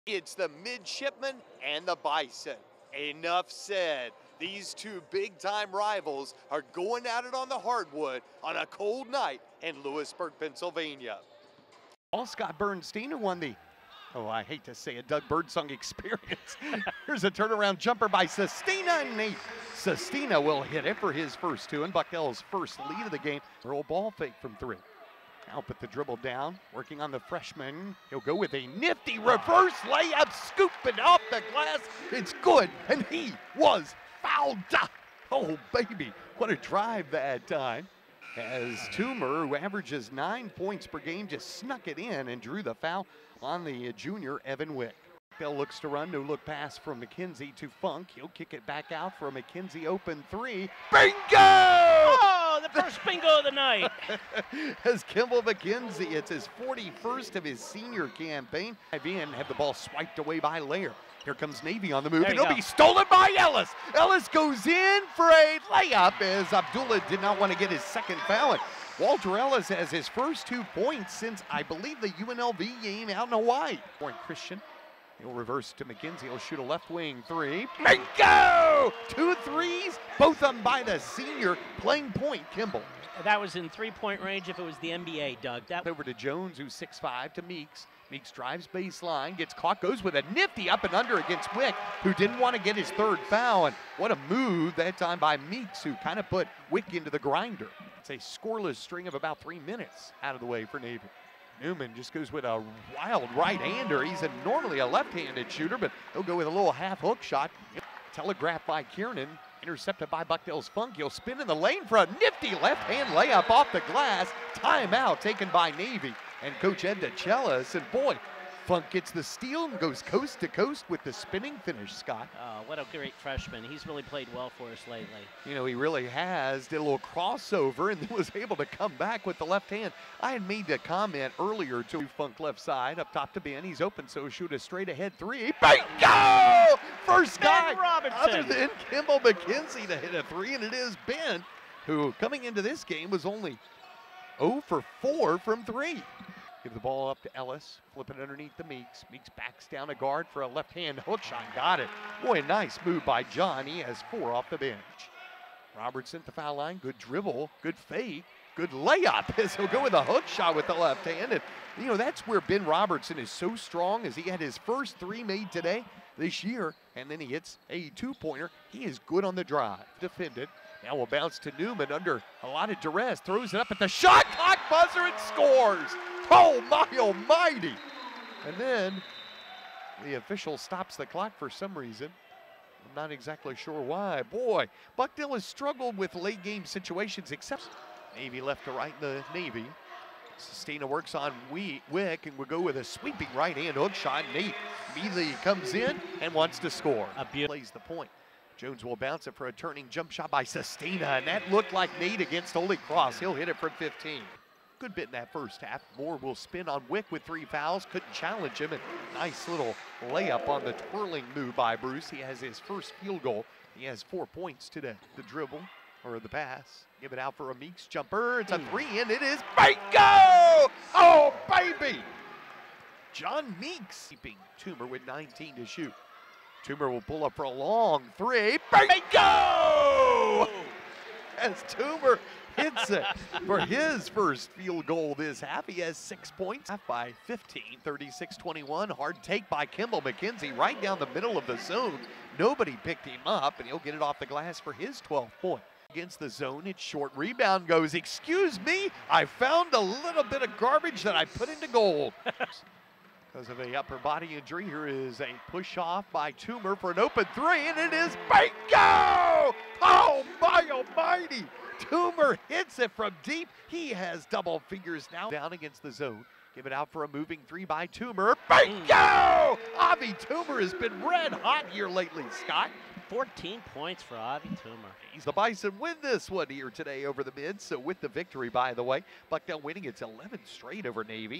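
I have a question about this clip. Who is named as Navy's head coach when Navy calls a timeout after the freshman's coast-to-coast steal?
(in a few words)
Ed DeChellis.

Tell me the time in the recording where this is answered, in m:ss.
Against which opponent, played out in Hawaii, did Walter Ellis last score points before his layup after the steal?
1:12.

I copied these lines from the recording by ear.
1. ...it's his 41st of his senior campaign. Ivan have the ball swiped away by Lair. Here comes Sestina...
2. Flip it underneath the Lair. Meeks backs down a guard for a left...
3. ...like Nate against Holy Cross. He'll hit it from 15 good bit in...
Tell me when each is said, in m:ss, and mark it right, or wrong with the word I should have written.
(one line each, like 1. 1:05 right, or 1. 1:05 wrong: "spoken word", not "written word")
1. 0:56 wrong: "Navy", not "Sestina"
2. 2:27 wrong: "Meeks", not "Lair"
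3. 3:21 right.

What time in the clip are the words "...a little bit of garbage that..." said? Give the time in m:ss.
4:09.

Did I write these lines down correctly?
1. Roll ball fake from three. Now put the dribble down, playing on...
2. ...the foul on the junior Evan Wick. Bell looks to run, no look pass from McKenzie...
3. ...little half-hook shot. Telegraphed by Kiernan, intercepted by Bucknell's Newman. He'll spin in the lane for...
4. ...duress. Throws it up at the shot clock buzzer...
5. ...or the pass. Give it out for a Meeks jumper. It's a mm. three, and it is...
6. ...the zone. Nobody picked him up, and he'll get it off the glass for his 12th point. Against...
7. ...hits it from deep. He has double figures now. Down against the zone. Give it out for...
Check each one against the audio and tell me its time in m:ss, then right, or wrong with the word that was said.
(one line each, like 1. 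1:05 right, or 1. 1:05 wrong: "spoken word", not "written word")
1. 0:23 wrong: "working", not "playing"
2. 0:42 right
3. 1:46 wrong: "Funk", not "Newman"
4. 2:52 right
5. 3:36 right
6. 4:01 right
7. 4:22 right.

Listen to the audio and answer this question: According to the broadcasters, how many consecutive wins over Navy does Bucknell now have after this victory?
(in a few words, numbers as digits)
11.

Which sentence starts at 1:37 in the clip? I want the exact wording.
It's a scoreless string of about three minutes out of the way for Navy.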